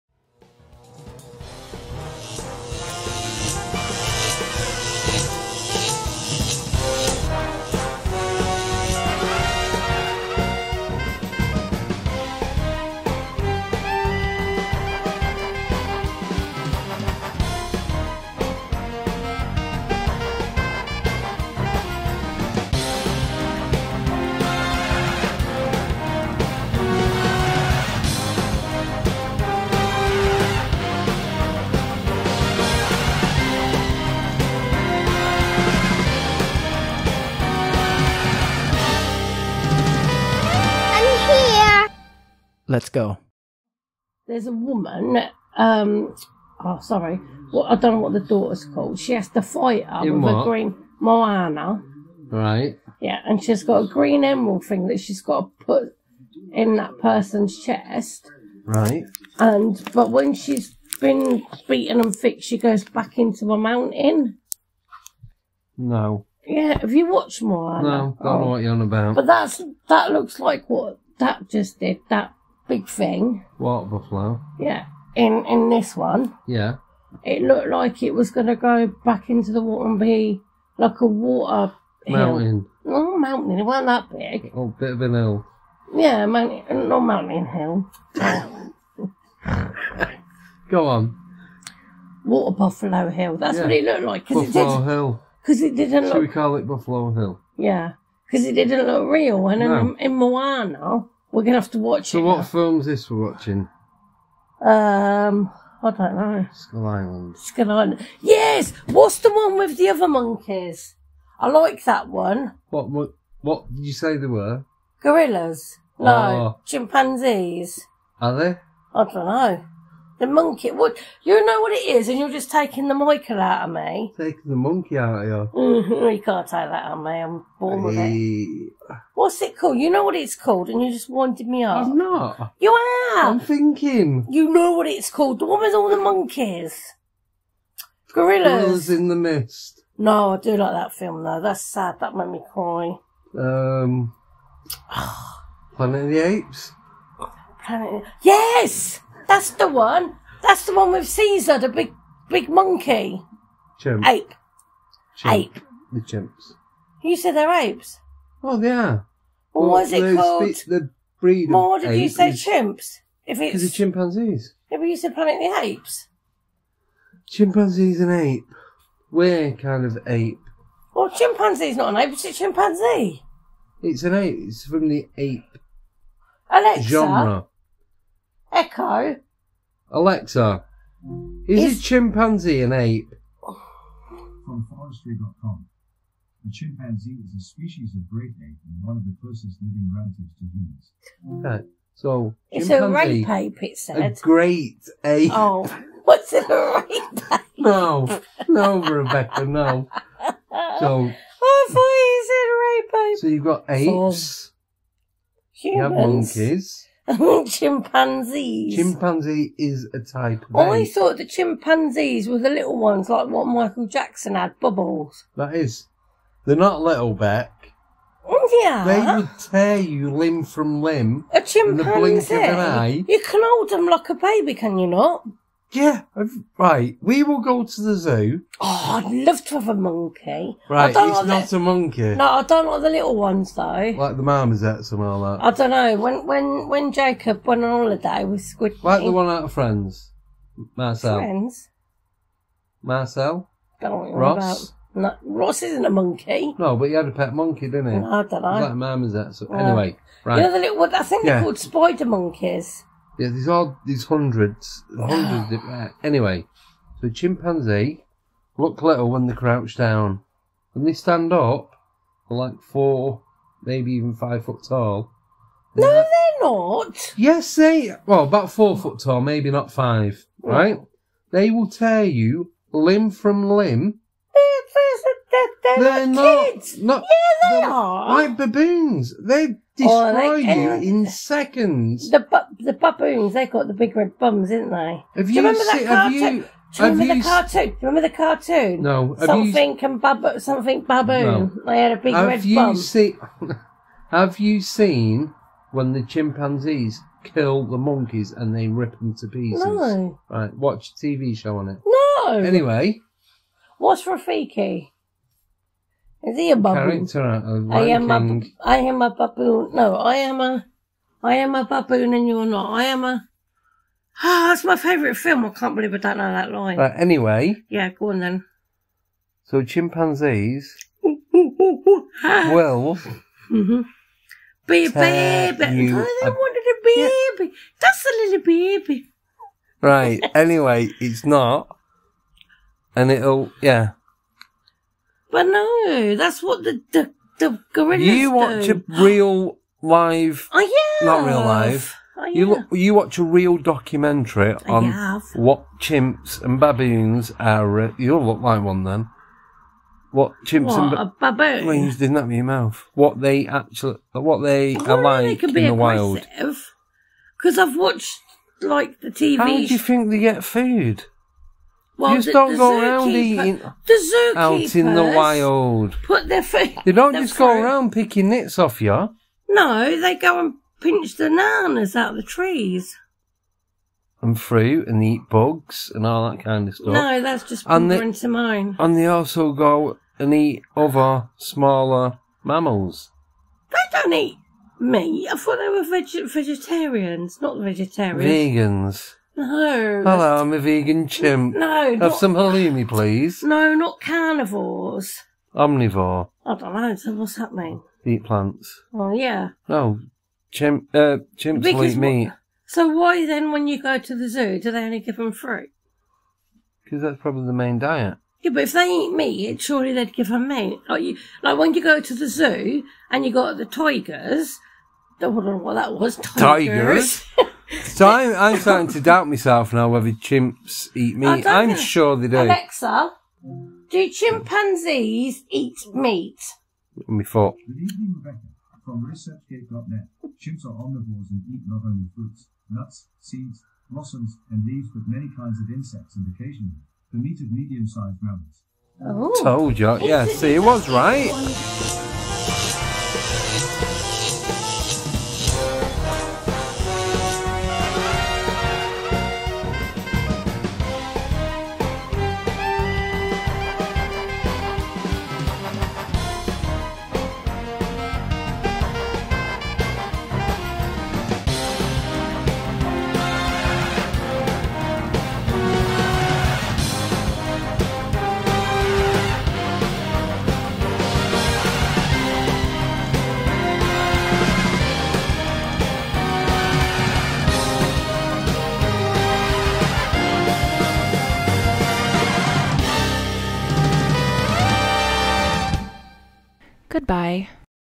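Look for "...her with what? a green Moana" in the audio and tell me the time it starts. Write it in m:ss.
0:49.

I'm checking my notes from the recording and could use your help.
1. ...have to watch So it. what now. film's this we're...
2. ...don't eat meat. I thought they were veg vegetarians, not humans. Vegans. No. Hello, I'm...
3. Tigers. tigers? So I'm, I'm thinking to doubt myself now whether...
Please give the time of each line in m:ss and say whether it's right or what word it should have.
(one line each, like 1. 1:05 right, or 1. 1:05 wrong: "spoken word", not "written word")
1. 1:41 right
2. 6:23 wrong: "vegetarians", not "humans"
3. 6:56 wrong: "starting", not "thinking".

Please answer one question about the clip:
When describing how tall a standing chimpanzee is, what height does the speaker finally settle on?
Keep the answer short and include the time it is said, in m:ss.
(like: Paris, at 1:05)
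About 4 feet, at 4:28.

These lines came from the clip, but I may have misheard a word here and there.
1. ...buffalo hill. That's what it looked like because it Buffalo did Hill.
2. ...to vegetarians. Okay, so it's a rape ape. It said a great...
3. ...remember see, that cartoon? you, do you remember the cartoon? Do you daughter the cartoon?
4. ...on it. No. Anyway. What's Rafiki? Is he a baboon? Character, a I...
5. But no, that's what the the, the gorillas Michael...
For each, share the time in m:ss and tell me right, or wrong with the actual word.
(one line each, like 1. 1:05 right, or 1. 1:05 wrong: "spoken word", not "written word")
1. 1:32 right
2. 3:10 wrong: "humans", not "vegetarians"
3. 4:45 wrong: "remember", not "daughter"
4. 5:01 right
5. 5:35 wrong: "You", not "Michael".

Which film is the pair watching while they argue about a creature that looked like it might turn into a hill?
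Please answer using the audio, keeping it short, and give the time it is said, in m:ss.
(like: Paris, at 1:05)
Skull Island, at 1:47.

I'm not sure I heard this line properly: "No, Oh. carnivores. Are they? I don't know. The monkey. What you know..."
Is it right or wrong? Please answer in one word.
wrong.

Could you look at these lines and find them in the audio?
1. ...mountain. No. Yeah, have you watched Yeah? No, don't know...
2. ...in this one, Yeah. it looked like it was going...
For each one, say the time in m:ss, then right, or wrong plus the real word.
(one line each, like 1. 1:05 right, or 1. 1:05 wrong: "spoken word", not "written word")
1. 1:03 wrong: "Moana", not "Yeah"
2. 1:15 right.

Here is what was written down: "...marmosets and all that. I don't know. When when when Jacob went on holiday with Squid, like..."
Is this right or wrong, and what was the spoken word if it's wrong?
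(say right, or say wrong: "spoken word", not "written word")
right.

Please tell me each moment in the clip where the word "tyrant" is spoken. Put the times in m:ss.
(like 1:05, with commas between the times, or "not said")
not said.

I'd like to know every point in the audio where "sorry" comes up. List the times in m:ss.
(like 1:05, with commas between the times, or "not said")
0:46.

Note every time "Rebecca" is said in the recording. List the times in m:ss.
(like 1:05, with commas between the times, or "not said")
3:18, 7:08.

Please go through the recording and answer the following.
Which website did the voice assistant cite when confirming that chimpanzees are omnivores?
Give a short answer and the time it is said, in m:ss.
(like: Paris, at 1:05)
ResearchGate.net, at 7:09.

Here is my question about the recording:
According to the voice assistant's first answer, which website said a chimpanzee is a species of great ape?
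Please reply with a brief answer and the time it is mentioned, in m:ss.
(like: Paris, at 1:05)
forestry.com, at 3:04.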